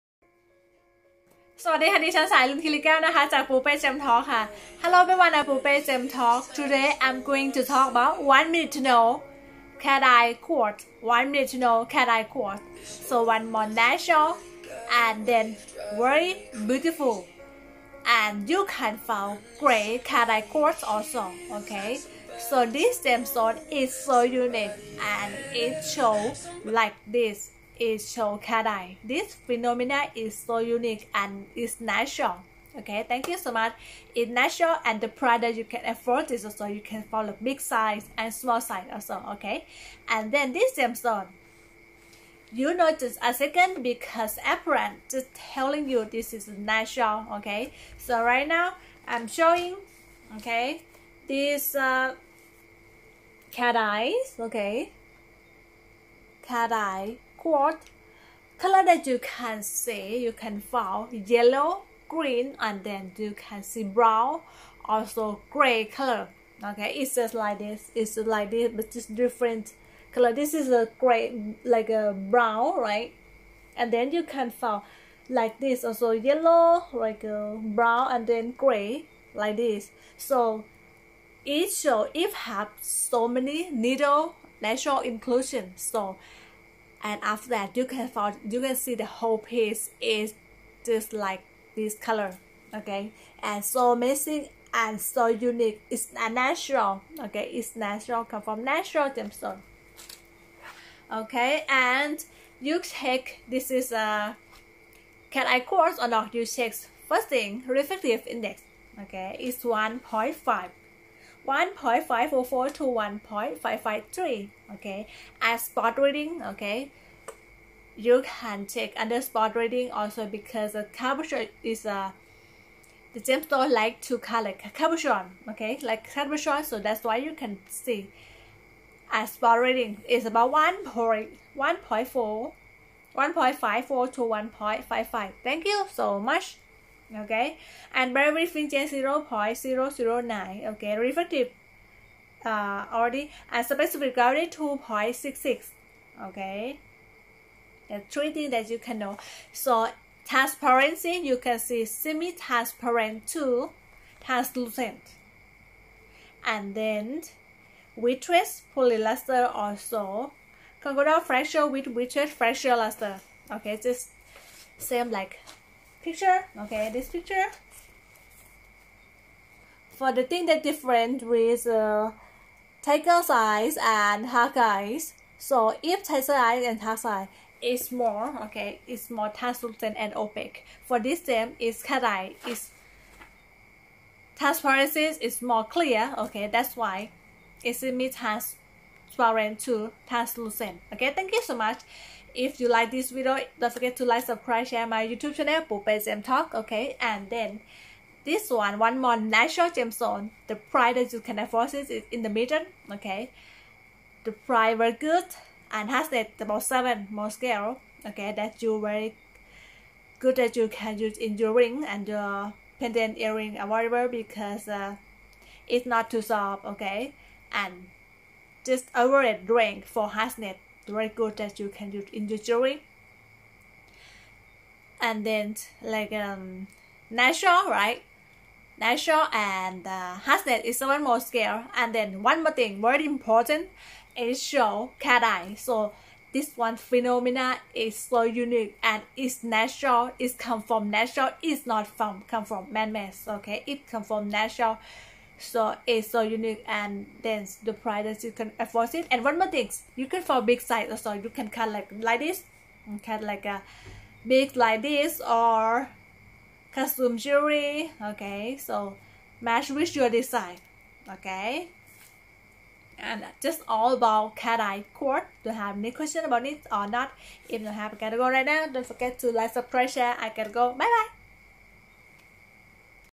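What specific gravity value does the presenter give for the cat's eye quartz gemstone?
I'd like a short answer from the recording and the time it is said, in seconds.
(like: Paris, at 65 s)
2.66, at 143 s.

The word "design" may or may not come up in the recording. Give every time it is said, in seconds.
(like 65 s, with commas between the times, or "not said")
260 s.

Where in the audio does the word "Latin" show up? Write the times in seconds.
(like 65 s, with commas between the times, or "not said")
not said.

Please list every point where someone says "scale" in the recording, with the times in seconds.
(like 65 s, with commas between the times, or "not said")
207 s, 231 s.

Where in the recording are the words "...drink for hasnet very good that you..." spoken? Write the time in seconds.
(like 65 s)
219 s.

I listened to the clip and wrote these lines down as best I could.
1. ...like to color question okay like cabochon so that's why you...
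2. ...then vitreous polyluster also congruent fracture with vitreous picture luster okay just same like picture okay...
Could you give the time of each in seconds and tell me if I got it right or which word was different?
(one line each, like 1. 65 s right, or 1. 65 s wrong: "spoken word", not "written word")
1. 123 s wrong: "cabochon", not "question"
2. 156 s wrong: "fracture", not "picture".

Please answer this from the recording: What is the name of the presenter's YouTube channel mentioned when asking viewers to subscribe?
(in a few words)
Pupe Gem Talk.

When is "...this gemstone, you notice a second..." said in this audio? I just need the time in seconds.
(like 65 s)
40 s.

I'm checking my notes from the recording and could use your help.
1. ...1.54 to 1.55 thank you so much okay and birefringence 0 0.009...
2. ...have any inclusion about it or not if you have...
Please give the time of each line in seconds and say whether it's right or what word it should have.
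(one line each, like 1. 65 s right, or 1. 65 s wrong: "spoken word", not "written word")
1. 131 s right
2. 265 s wrong: "question", not "inclusion".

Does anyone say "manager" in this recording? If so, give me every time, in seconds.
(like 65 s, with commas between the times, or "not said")
not said.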